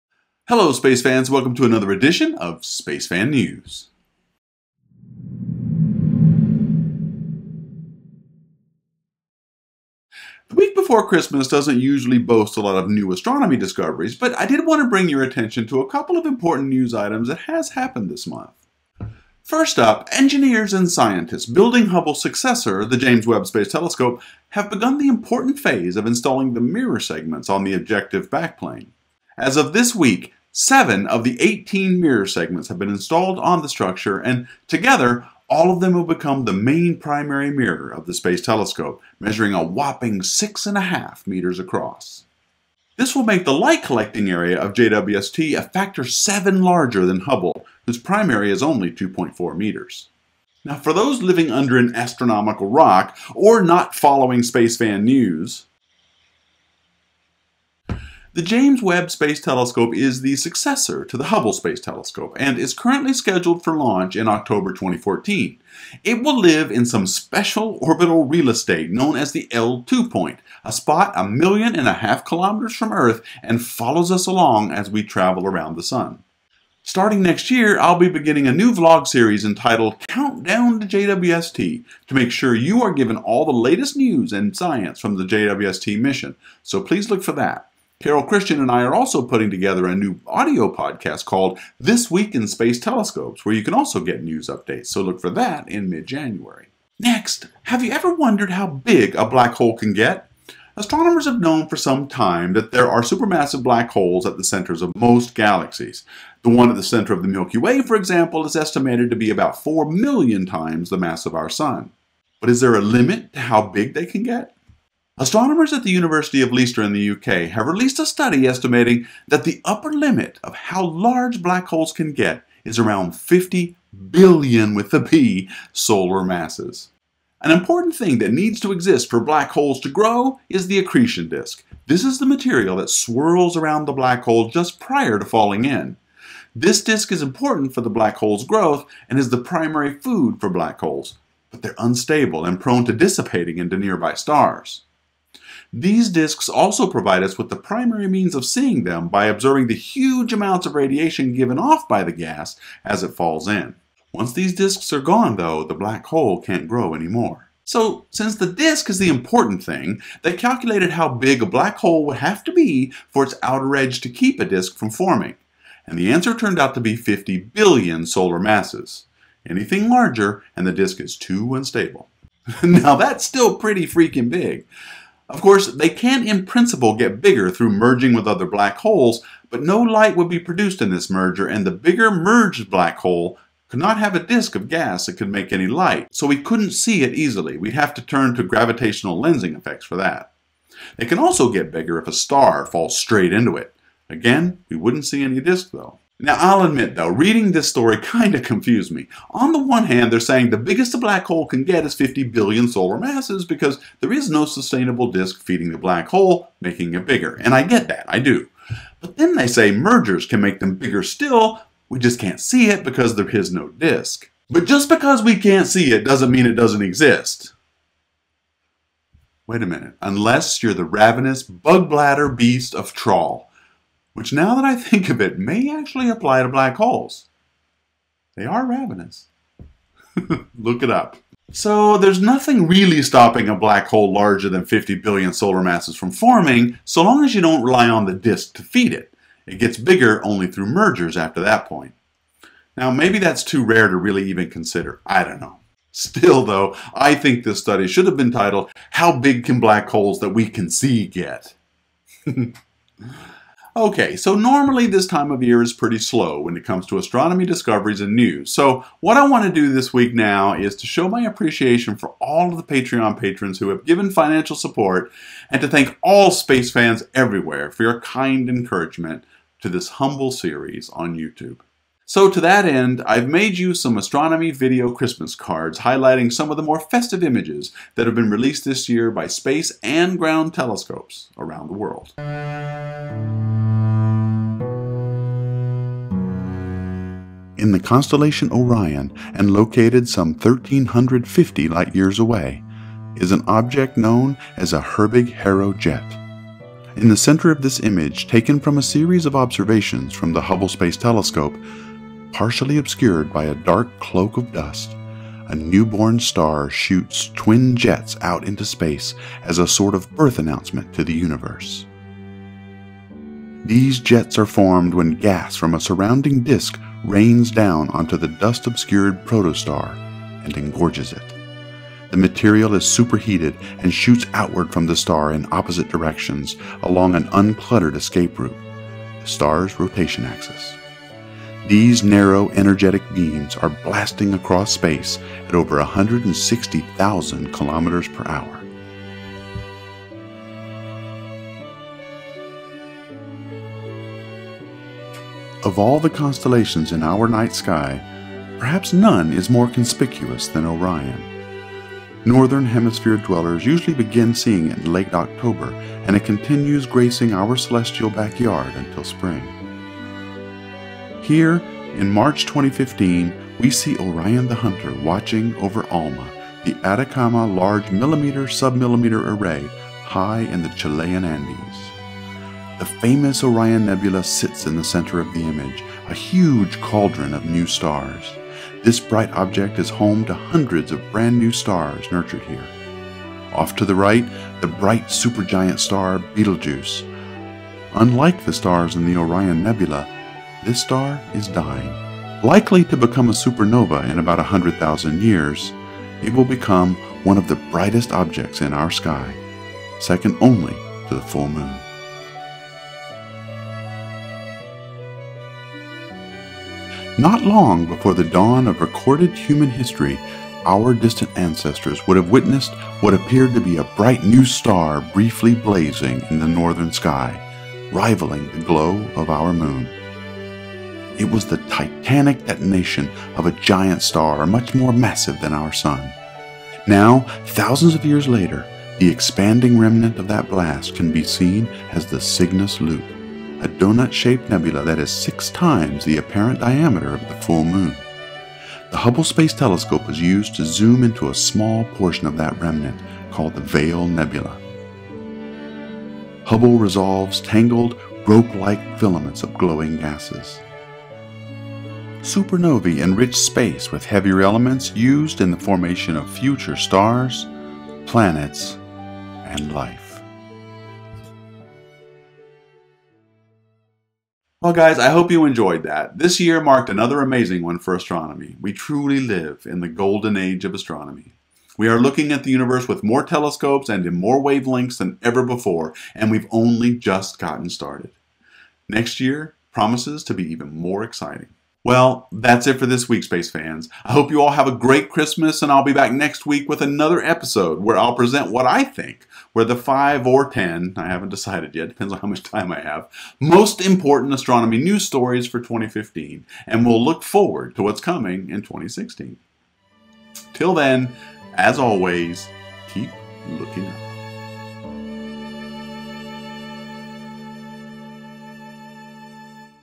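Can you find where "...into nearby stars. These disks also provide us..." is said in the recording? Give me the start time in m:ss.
2:23.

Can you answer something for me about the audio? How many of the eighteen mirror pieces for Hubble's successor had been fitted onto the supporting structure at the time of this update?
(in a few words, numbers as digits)
7.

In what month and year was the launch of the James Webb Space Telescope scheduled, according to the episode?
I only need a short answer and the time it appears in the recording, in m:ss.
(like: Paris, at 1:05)
October 2014, at 1:04.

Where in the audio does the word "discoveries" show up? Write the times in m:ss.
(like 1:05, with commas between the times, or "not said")
0:13, 4:17.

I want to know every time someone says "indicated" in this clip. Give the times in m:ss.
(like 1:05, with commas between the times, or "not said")
not said.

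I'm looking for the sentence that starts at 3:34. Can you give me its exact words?
But just because we can't see it doesn't mean it doesn't exist.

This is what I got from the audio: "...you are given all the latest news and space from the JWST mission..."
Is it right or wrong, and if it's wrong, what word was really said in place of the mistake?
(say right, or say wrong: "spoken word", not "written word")
wrong: "science", not "space".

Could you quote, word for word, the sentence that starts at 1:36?
Next, have you ever wondered how big a black hole can get?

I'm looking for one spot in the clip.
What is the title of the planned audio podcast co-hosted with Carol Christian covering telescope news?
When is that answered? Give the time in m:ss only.
1:31.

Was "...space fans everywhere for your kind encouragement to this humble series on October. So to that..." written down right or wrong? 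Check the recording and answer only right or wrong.
wrong.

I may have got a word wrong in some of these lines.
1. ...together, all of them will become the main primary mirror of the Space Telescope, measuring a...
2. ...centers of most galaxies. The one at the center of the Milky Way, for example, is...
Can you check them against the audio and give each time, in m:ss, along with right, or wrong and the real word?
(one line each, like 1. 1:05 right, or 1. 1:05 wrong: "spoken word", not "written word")
1. 0:34 right
2. 1:44 right.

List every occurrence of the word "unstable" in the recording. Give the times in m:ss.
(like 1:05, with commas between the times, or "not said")
2:21, 2:51.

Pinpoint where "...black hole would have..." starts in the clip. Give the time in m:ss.
2:41.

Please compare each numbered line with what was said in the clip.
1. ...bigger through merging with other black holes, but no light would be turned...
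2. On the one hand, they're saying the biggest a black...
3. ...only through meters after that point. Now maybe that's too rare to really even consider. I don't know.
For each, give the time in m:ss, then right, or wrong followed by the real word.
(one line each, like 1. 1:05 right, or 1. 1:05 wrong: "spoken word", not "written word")
1. 2:57 wrong: "produced", not "turned"
2. 3:19 right
3. 4:00 wrong: "mergers", not "meters".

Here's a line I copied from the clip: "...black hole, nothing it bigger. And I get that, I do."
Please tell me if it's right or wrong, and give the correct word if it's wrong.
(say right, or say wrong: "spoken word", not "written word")
wrong: "making", not "nothing".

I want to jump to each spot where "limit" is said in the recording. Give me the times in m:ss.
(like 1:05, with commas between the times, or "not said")
1:52, 1:59.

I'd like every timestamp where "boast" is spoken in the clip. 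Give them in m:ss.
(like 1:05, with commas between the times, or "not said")
0:12.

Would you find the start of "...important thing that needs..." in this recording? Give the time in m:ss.
2:07.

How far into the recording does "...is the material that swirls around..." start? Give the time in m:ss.
2:12.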